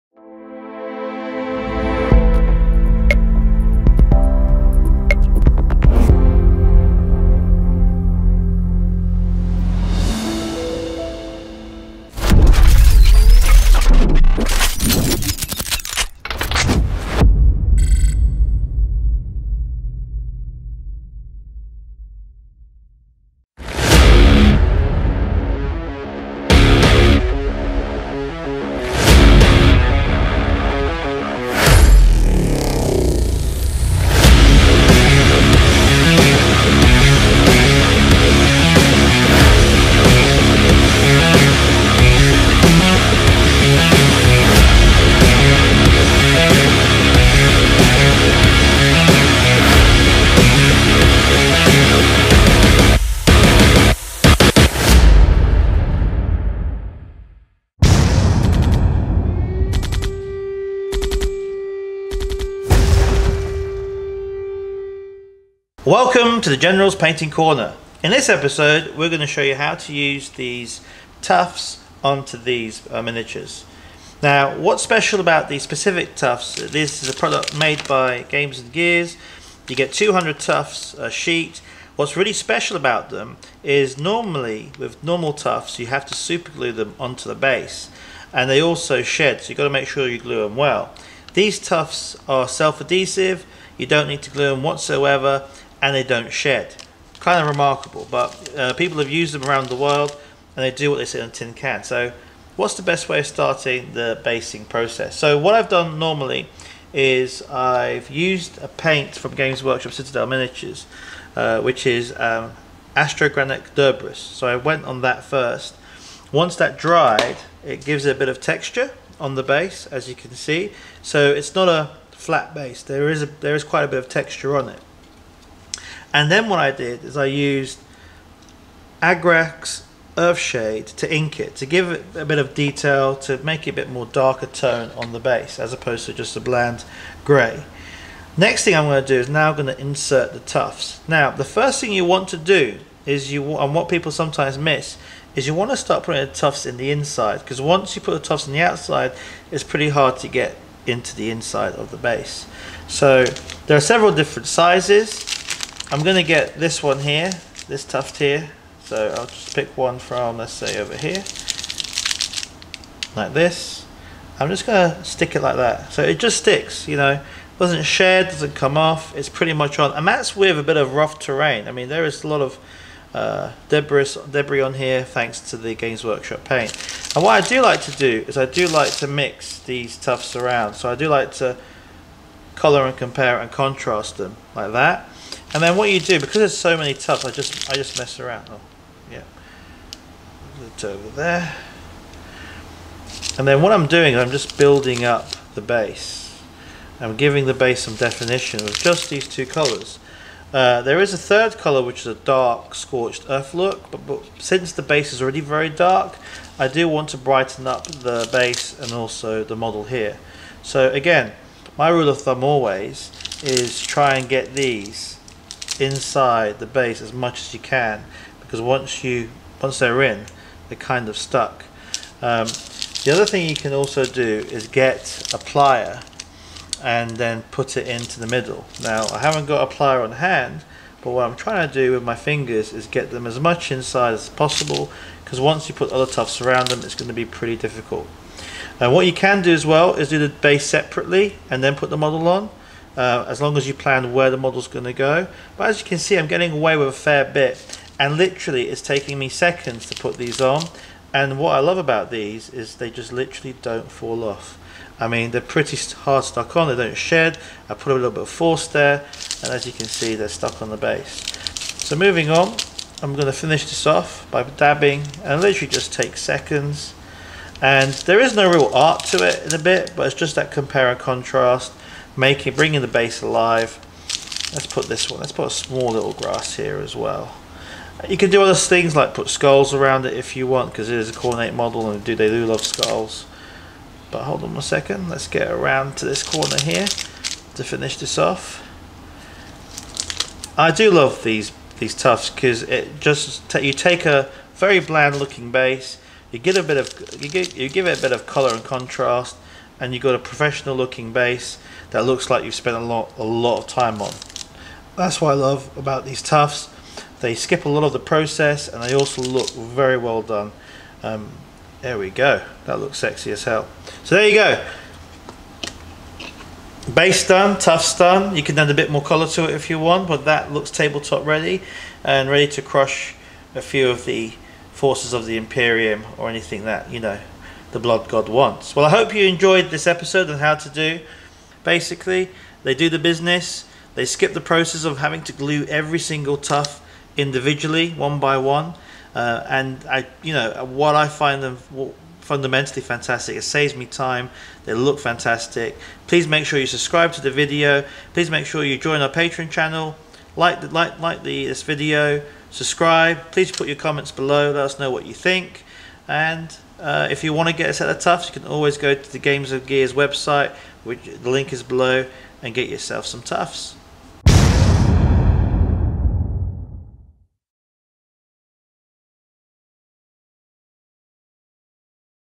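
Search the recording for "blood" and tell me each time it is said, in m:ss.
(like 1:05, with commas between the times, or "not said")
5:27.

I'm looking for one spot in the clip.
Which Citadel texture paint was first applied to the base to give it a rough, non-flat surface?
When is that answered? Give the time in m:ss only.
1:52.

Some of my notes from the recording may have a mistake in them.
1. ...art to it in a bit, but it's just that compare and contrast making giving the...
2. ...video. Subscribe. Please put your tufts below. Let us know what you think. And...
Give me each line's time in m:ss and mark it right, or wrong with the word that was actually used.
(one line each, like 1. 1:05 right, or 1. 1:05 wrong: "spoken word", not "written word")
1. 4:28 wrong: "bringing", not "giving"
2. 5:51 wrong: "comments", not "tufts".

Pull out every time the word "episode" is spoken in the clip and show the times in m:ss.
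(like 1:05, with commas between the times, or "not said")
1:08, 5:29.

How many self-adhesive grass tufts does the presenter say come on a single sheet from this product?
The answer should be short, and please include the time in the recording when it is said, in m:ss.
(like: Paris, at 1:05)
200, at 1:19.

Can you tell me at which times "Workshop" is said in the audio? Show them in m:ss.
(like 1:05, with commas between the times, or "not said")
1:49, 2:56.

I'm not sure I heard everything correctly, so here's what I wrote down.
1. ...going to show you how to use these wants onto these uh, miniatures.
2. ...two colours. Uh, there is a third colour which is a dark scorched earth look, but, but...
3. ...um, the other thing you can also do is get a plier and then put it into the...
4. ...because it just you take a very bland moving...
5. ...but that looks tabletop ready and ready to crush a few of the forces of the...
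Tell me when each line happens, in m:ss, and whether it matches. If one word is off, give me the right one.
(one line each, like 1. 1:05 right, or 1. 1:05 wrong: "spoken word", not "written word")
1. 1:09 wrong: "tufts", not "wants"
2. 3:19 right
3. 3:42 right
4. 4:52 wrong: "looking", not "moving"
5. 5:20 right.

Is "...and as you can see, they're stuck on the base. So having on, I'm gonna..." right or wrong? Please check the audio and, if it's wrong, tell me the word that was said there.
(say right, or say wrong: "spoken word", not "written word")
wrong: "moving", not "having".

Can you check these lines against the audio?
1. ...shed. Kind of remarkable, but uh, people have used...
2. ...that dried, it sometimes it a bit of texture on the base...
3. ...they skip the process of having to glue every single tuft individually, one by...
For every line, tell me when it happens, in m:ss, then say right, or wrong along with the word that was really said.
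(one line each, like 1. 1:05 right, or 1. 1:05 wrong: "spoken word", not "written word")
1. 1:36 right
2. 1:56 wrong: "gives", not "sometimes"
3. 5:33 right.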